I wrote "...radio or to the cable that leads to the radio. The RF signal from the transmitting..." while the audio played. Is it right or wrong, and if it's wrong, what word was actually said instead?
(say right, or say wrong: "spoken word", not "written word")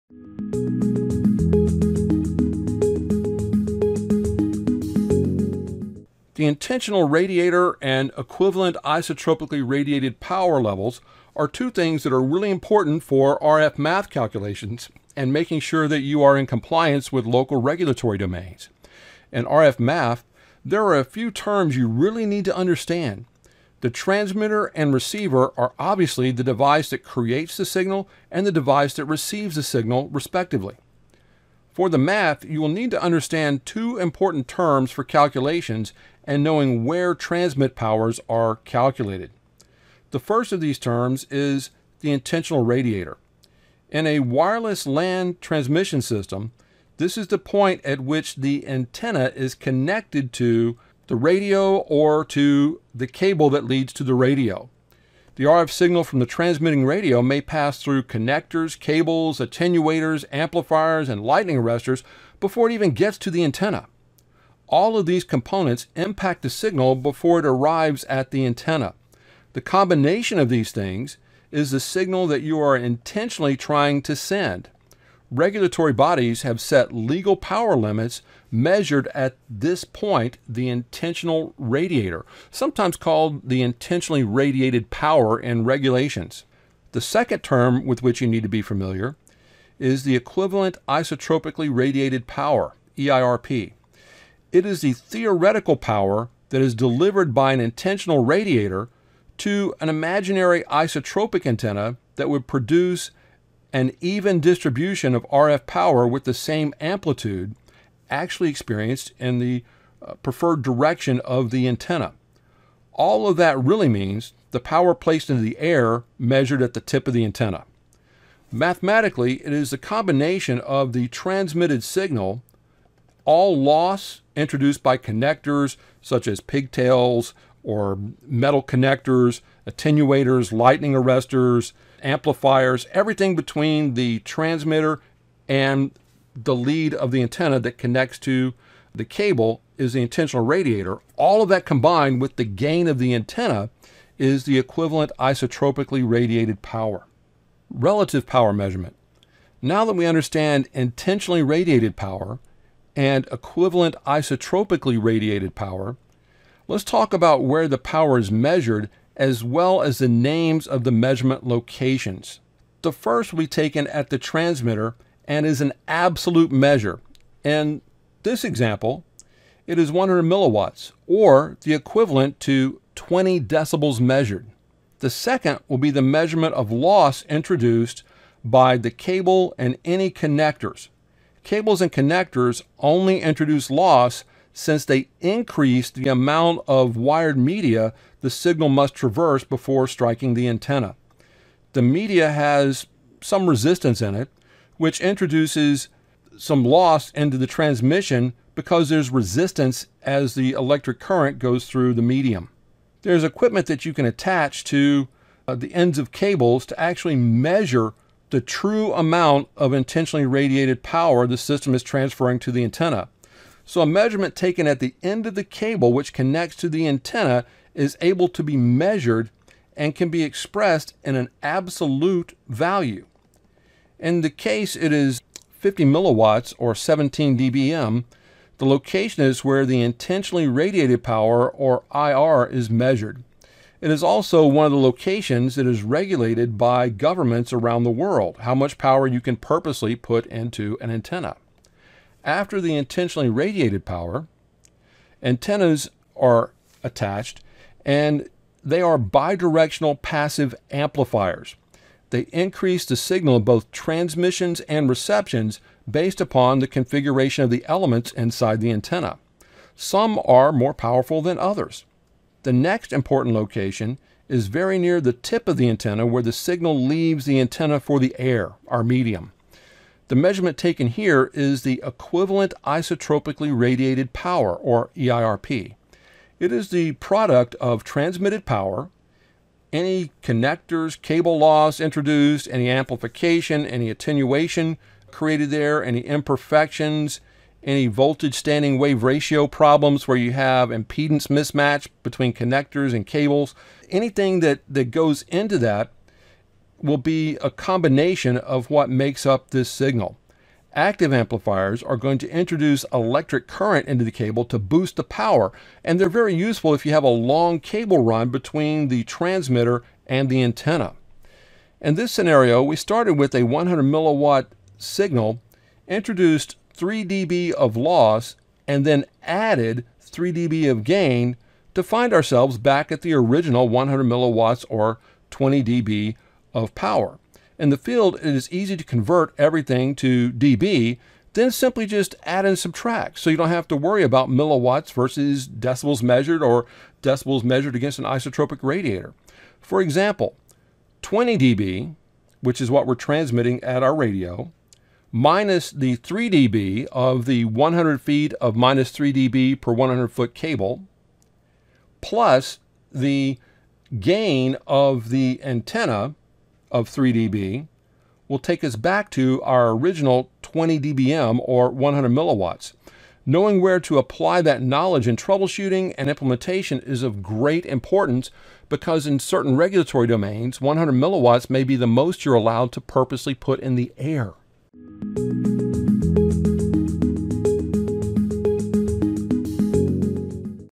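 right.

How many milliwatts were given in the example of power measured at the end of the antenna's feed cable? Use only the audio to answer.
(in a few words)
50 milliwatts.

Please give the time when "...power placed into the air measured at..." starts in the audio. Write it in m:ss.
1:54.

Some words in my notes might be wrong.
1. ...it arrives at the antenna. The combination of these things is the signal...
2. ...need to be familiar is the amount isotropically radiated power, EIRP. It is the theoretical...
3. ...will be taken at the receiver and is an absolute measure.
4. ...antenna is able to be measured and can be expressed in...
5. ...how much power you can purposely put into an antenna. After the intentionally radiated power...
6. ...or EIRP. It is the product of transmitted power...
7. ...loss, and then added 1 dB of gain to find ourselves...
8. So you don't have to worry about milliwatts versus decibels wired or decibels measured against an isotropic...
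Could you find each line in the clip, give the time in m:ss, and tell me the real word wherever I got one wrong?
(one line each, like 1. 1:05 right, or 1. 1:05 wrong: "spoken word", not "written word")
1. 1:07 right
2. 1:28 wrong: "equivalent", not "amount"
3. 2:43 wrong: "transmitter", not "receiver"
4. 3:36 right
5. 3:58 right
6. 4:34 right
7. 5:17 wrong: "3", not "1"
8. 5:33 wrong: "measured", not "wired".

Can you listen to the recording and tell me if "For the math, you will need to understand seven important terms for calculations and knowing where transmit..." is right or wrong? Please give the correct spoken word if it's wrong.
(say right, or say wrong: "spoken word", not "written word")
wrong: "two", not "seven".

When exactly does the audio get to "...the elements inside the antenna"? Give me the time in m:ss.
4:17.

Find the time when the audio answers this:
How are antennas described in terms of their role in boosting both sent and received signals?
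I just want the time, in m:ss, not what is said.
4:08.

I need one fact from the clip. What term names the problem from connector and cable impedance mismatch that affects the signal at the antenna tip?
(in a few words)
voltage standing wave ratio.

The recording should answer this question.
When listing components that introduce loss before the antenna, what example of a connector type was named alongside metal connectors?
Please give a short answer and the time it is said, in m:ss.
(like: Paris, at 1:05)
pigtails, at 2:06.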